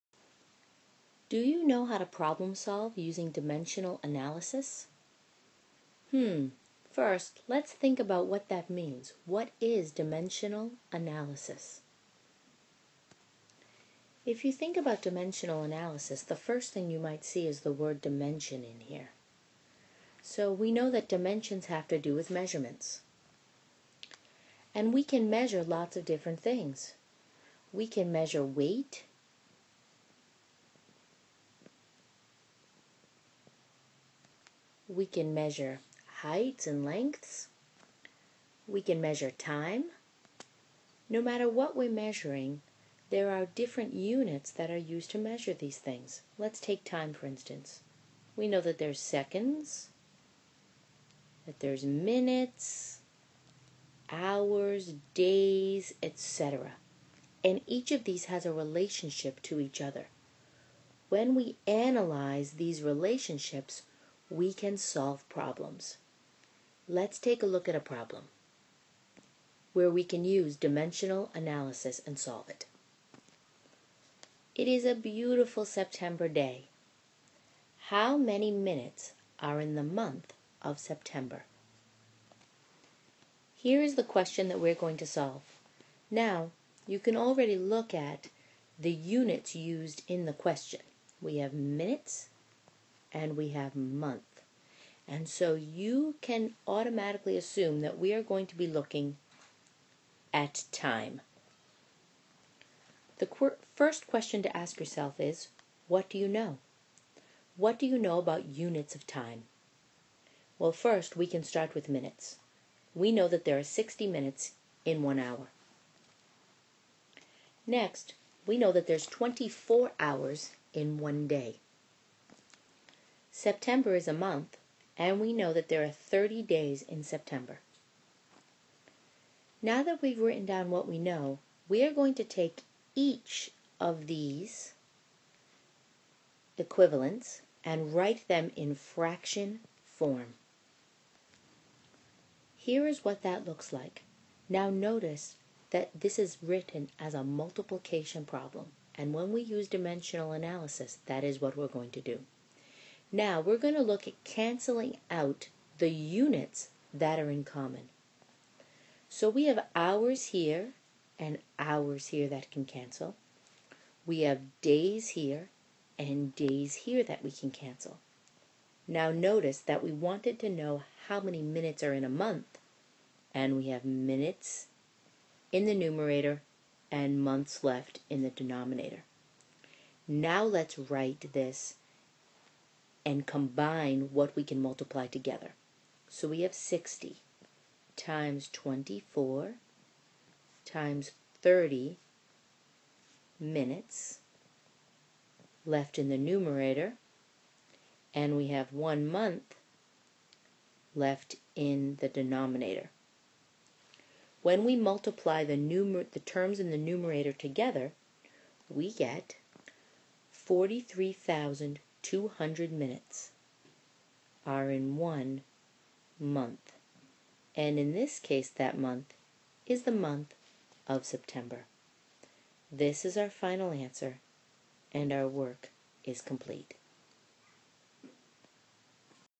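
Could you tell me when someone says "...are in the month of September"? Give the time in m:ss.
1:19.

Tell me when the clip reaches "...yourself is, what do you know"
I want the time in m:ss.
1:44.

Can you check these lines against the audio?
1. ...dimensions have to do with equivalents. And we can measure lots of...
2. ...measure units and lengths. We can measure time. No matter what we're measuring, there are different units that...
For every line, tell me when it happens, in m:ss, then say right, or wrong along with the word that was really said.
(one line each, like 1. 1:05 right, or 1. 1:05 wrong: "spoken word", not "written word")
1. 0:21 wrong: "measurements", not "equivalents"
2. 0:35 wrong: "heights", not "units".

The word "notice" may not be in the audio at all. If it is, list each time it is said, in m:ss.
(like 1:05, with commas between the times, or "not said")
2:24, 2:49.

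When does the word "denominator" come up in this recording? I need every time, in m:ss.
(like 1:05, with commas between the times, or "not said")
2:58, 3:22.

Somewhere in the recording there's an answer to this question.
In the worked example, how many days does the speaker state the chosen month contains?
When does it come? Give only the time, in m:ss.
2:05.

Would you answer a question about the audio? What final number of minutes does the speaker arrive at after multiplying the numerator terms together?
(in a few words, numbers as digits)
43,200.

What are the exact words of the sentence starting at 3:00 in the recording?
Now let's write this and combine what we can multiply together.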